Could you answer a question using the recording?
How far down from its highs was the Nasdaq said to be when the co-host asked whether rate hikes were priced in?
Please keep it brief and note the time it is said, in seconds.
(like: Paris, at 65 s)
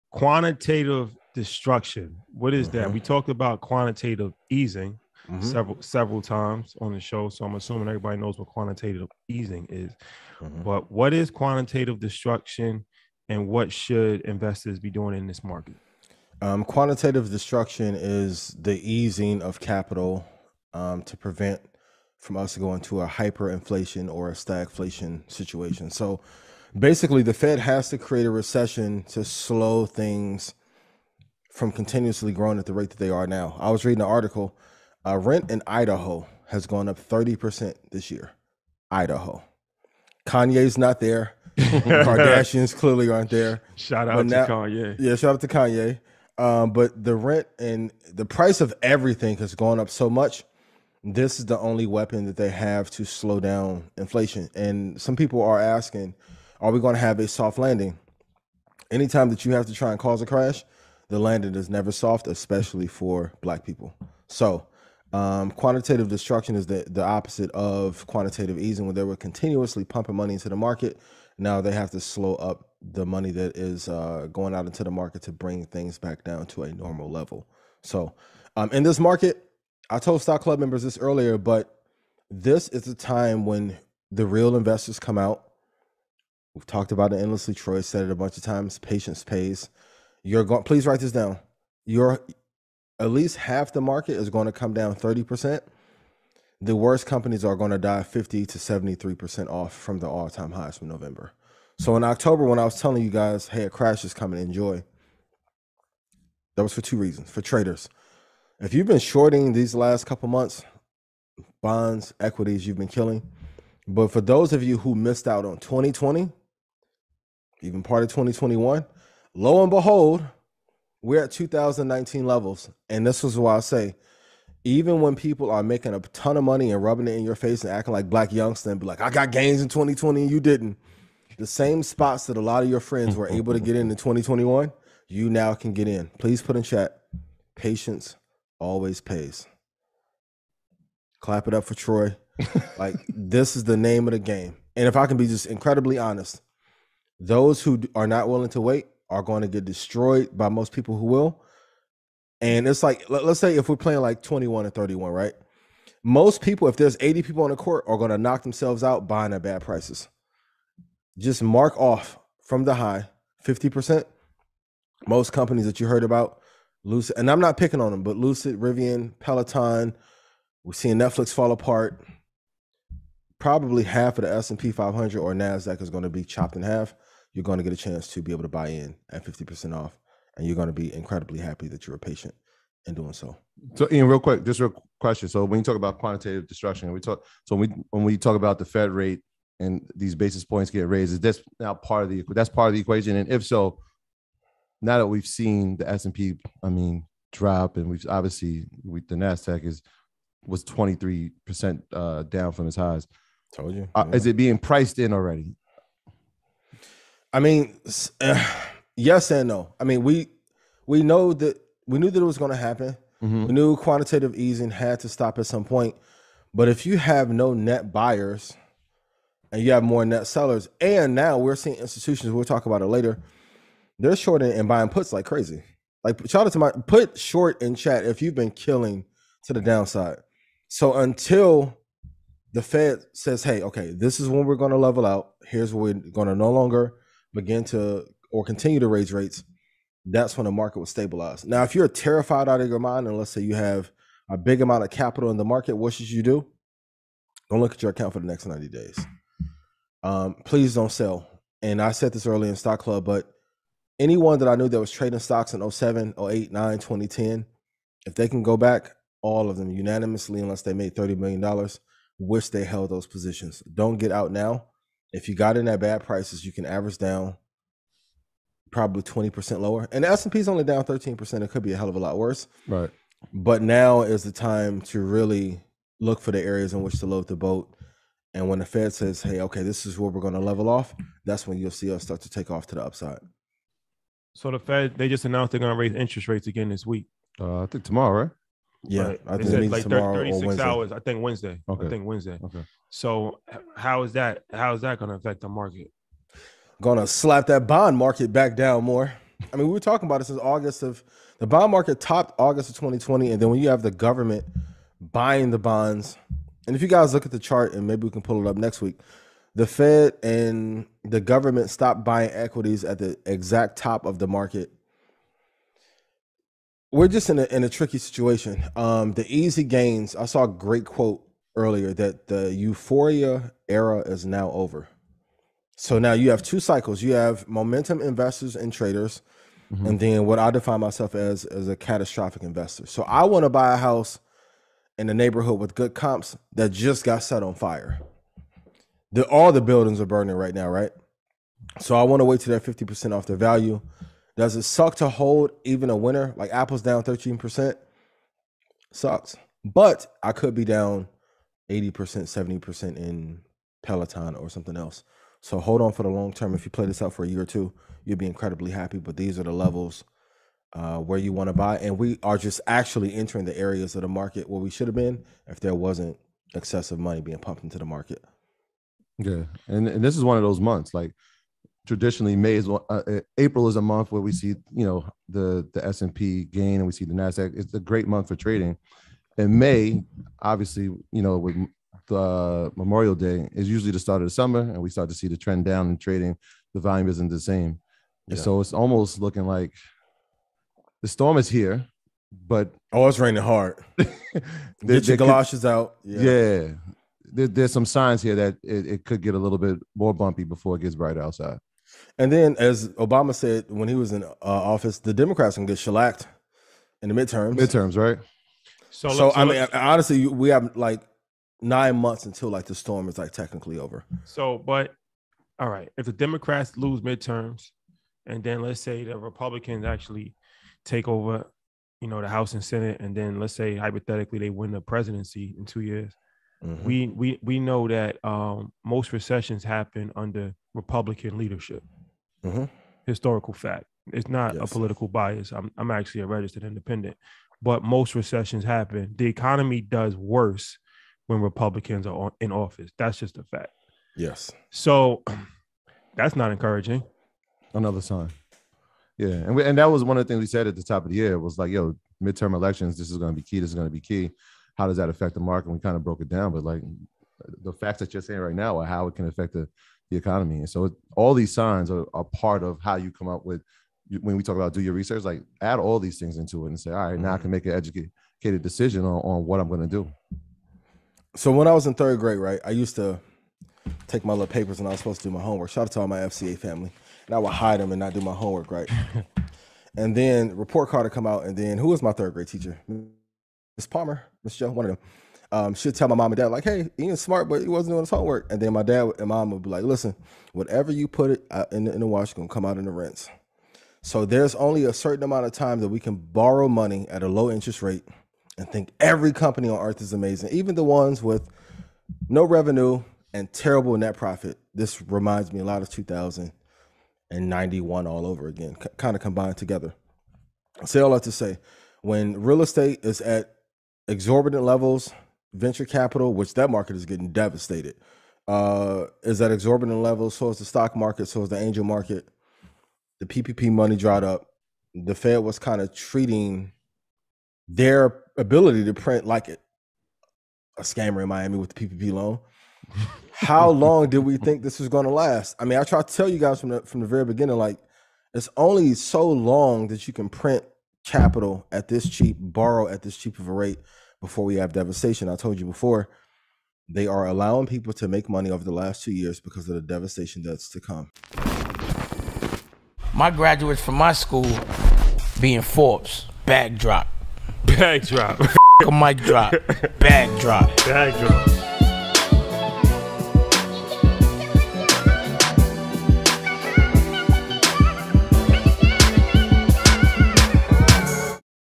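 23%, at 200 s.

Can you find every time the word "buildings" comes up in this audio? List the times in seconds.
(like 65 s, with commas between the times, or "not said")
339 s.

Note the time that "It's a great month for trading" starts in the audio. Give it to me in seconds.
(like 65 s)
377 s.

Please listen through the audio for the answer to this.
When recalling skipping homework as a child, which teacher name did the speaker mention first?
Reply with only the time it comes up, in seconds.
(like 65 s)
483 s.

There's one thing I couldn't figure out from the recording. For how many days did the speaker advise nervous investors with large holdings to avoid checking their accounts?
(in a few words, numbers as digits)
90 days.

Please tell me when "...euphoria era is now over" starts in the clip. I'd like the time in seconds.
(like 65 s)
322 s.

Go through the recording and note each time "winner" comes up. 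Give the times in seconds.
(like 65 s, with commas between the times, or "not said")
345 s.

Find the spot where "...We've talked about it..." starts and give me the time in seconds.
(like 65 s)
86 s.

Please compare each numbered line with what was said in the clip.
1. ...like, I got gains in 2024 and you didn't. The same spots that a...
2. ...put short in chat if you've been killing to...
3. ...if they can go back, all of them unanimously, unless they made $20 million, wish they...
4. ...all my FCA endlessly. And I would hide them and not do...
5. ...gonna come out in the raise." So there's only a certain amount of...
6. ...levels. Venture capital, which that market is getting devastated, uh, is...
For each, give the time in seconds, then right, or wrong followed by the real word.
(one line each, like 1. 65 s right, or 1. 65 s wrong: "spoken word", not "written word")
1. 128 s wrong: "2020", not "2024"
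2. 226 s right
3. 258 s wrong: "30", not "20"
4. 476 s wrong: "family", not "endlessly"
5. 492 s wrong: "rinse", not "raise"
6. 514 s right.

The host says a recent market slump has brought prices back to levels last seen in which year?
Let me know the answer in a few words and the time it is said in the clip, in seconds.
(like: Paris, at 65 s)
2019, at 121 s.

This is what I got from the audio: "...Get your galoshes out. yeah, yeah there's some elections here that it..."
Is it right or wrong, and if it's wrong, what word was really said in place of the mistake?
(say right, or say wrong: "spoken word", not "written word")
wrong: "signs", not "elections".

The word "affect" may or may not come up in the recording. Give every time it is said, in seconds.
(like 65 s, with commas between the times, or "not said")
295 s, 455 s, 459 s.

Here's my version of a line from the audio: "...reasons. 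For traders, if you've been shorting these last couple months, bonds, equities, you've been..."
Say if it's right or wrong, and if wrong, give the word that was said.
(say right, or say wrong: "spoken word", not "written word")
right.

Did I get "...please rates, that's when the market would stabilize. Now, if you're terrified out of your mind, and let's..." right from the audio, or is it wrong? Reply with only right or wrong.
wrong.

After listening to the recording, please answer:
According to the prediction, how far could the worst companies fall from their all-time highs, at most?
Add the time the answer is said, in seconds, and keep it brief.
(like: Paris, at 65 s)
73%, at 98 s.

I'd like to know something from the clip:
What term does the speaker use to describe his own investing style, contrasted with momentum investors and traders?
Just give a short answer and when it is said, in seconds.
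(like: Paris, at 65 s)
catastrophic investor, at 331 s.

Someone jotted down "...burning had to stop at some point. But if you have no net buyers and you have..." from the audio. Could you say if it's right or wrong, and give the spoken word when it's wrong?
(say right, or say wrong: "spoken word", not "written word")
wrong: "easing", not "burning".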